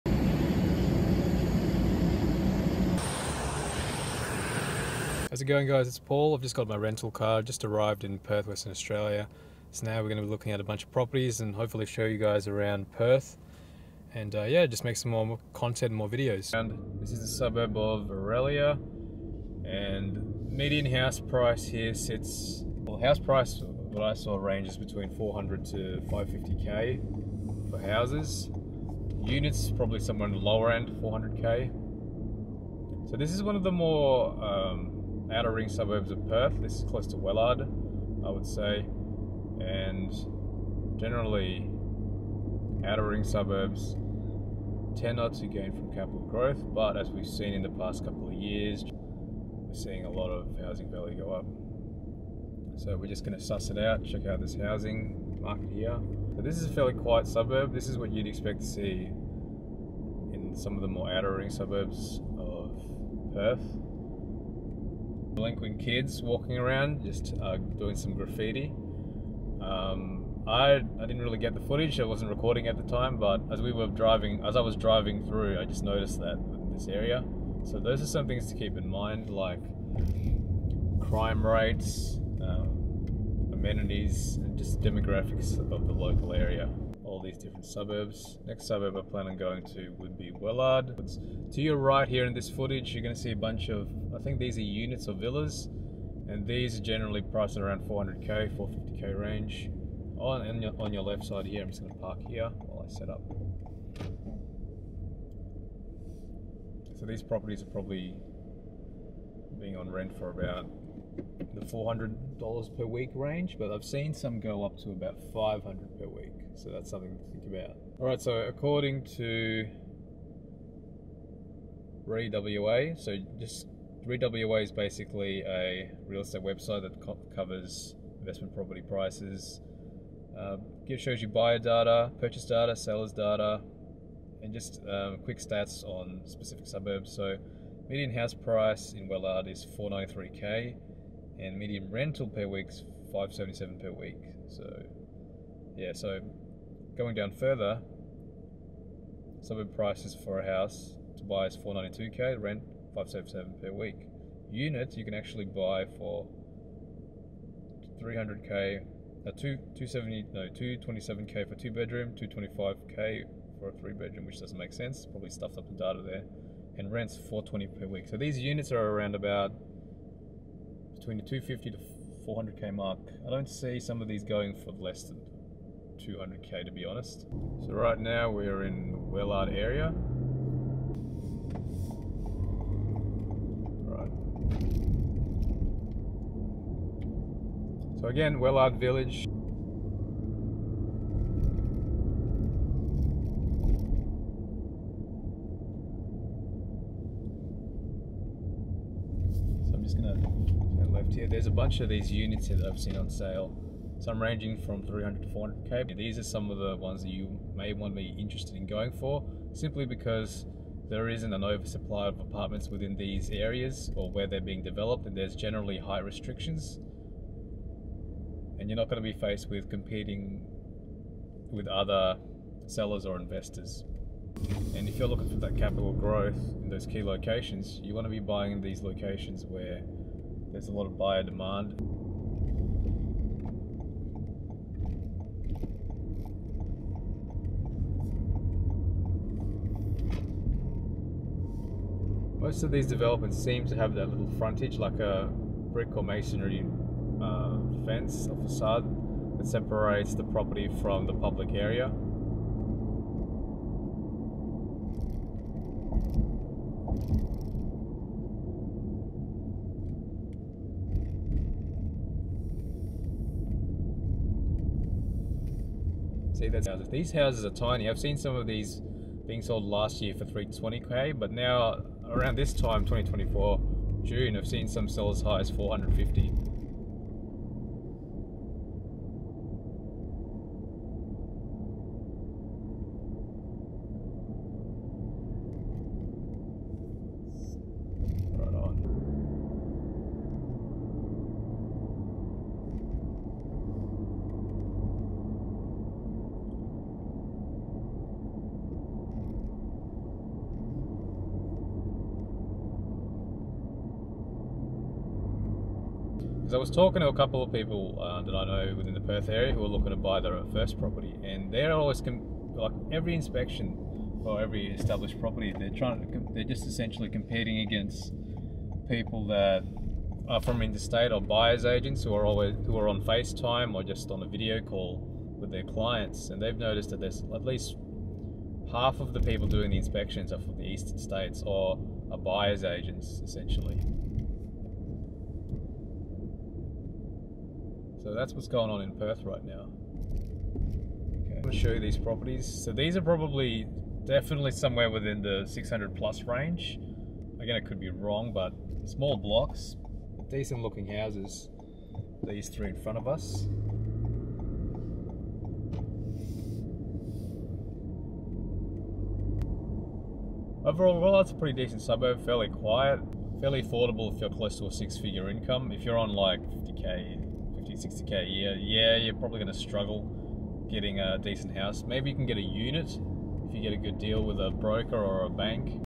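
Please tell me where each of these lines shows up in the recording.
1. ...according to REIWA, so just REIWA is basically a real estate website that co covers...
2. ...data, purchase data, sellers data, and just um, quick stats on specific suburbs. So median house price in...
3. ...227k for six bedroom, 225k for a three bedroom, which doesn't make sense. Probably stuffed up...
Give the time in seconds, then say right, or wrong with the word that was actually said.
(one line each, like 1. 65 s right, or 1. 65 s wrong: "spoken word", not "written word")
1. 118 s right
2. 131 s right
3. 160 s wrong: "two", not "six".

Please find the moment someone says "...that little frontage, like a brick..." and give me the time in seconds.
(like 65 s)
243 s.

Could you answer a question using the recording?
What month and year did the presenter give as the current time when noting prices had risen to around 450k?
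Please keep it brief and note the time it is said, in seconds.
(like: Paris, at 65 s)
June 2024, at 272 s.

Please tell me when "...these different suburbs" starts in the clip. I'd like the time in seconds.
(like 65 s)
87 s.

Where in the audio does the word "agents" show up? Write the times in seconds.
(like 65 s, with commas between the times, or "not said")
321 s, 332 s.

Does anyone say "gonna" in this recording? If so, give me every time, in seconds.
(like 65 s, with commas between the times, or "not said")
199 s, 341 s.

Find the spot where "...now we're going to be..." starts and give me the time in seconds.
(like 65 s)
9 s.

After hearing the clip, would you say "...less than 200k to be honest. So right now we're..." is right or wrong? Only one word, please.
right.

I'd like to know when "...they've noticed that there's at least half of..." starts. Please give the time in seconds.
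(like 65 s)
326 s.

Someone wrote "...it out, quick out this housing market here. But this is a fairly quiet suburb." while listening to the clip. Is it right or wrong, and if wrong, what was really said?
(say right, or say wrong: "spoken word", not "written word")
wrong: "check", not "quick".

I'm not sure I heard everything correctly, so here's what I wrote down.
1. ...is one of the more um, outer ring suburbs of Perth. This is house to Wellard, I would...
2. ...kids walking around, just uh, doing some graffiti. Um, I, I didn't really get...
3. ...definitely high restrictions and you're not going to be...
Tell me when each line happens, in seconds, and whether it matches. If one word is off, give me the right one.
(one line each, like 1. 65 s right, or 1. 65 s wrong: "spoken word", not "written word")
1. 33 s wrong: "close", not "house"
2. 65 s right
3. 215 s wrong: "generally", not "definitely".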